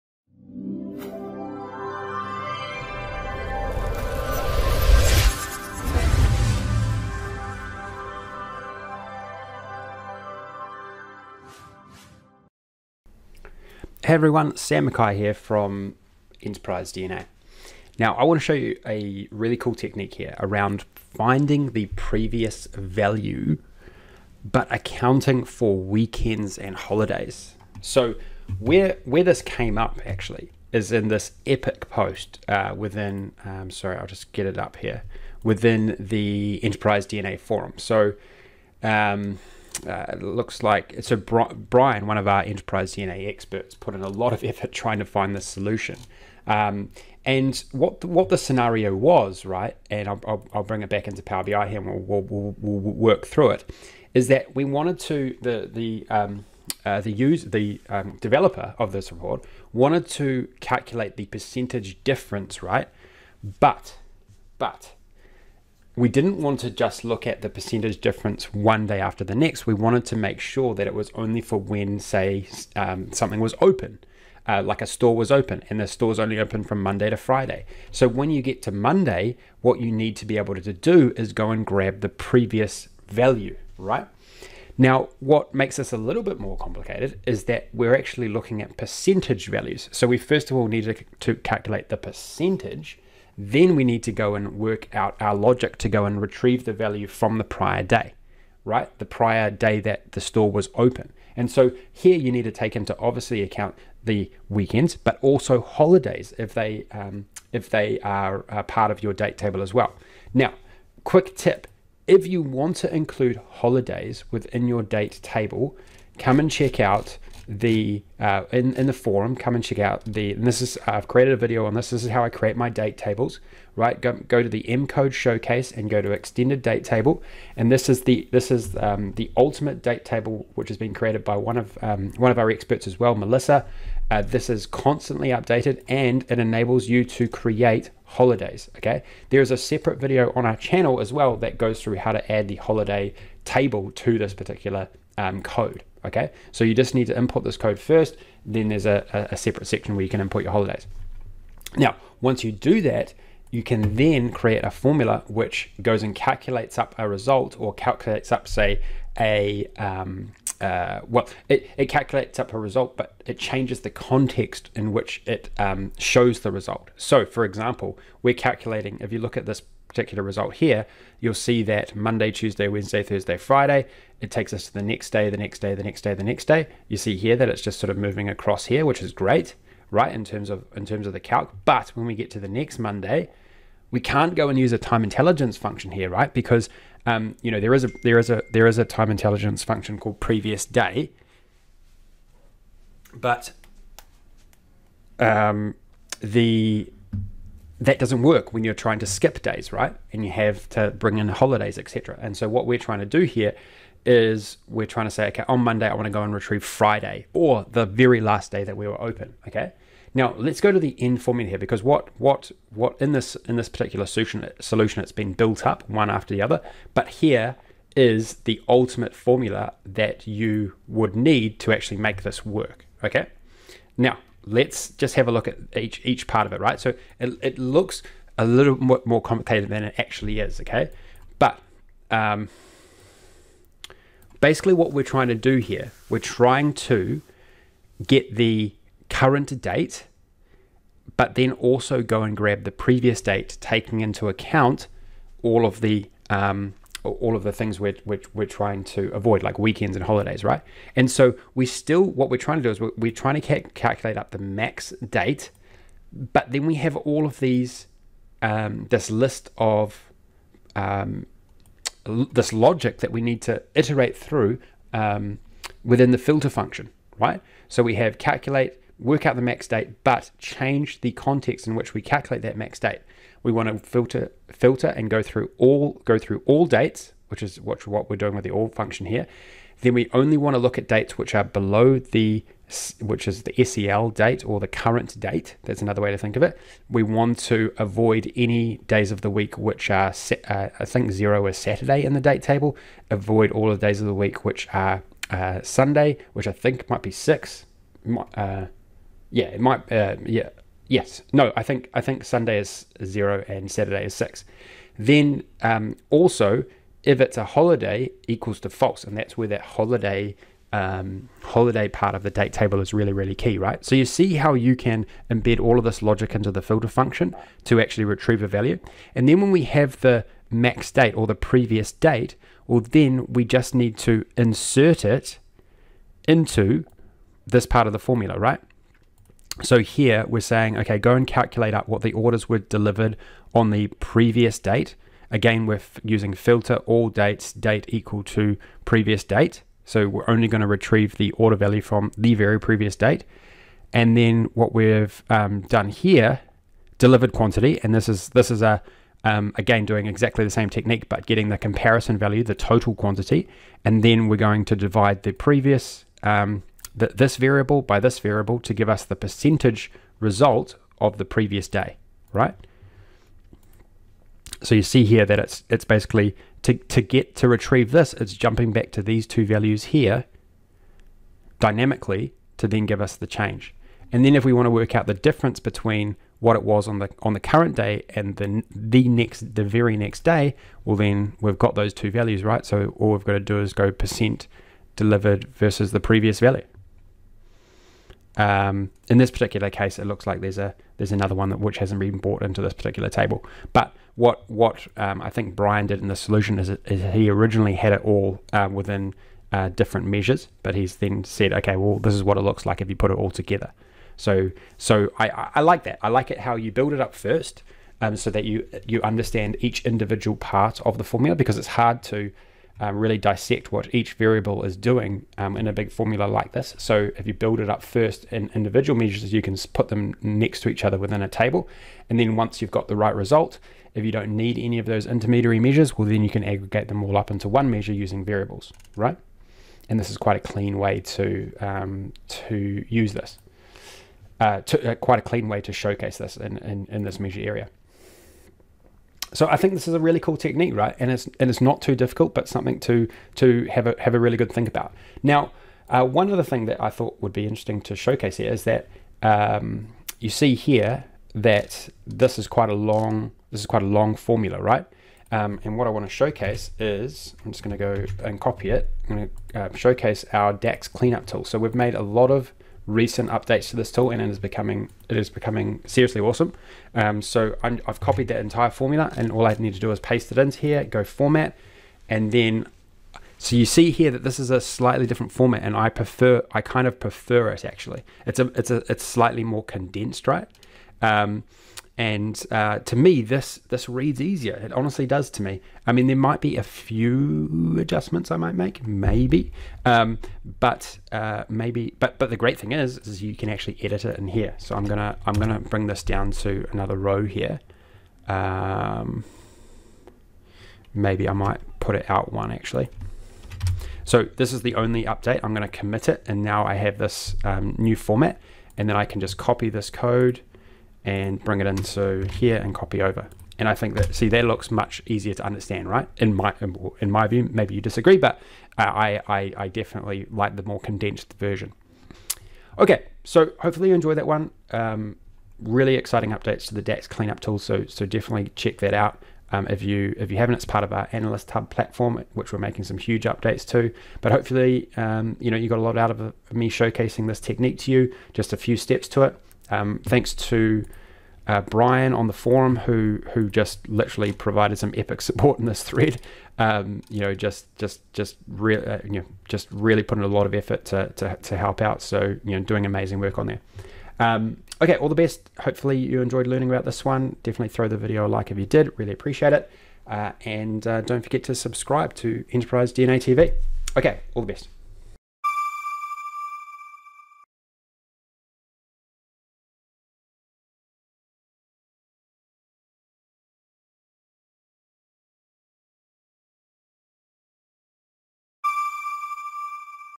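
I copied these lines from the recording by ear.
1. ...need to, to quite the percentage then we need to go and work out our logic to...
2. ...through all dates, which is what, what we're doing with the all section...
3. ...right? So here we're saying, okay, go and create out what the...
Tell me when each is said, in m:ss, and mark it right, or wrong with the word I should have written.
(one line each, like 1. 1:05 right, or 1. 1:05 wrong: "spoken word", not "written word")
1. 1:30 wrong: "calculate", not "quite"
2. 4:36 wrong: "function", not "section"
3. 5:28 wrong: "calculate", not "create".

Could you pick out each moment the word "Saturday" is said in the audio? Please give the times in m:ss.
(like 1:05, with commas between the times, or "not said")
4:51, 5:03.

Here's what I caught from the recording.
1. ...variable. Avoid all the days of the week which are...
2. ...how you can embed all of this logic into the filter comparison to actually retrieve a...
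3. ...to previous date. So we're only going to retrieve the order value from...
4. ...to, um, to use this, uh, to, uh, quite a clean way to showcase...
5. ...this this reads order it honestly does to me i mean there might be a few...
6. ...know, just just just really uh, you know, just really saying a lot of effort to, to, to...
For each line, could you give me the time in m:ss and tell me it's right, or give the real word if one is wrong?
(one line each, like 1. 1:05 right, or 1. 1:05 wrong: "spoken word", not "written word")
1. 4:52 wrong: "table", not "variable"
2. 5:14 wrong: "function", not "comparison"
3. 5:38 right
4. 7:11 right
5. 8:03 wrong: "easier", not "order"
6. 9:07 wrong: "putting", not "saying".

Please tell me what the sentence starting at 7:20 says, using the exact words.
And it's and it's not too difficult, but something to to have a have a really good think about.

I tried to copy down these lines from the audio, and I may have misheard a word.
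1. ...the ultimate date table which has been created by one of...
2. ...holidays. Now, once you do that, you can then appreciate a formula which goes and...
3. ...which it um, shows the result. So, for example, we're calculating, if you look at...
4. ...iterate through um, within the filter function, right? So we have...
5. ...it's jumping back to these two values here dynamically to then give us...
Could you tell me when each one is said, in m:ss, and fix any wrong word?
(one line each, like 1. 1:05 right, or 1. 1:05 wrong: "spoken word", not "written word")
1. 2:09 right
2. 2:30 wrong: "create", not "appreciate"
3. 2:44 right
4. 4:23 right
5. 6:08 right.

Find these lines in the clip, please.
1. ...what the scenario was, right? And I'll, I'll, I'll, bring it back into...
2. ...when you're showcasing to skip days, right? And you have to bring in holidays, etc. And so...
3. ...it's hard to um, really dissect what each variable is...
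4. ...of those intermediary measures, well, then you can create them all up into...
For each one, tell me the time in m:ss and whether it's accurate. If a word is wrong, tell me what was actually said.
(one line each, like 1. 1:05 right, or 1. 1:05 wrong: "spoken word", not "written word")
1. 0:48 right
2. 3:18 wrong: "trying", not "showcasing"
3. 6:51 right
4. 7:04 wrong: "aggregate", not "create".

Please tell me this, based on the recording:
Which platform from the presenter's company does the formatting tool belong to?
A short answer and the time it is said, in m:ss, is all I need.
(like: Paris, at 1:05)
Analyst Hub, at 8:51.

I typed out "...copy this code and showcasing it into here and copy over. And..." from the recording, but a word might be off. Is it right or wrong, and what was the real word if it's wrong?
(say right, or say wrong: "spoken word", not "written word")
wrong: "bring", not "showcasing".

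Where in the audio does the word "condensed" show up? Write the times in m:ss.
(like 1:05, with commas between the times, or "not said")
7:59, 8:40.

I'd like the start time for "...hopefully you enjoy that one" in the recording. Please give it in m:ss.
8:43.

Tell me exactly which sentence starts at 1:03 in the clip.
But but we didn't want to just look at the percentage difference one day after the next.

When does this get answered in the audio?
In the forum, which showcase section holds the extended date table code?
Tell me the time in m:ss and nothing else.
2:04.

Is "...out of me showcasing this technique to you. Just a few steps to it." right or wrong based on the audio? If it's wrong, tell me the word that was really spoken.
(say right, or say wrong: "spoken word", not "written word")
right.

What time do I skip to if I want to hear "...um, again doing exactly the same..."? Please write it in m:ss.
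5:49.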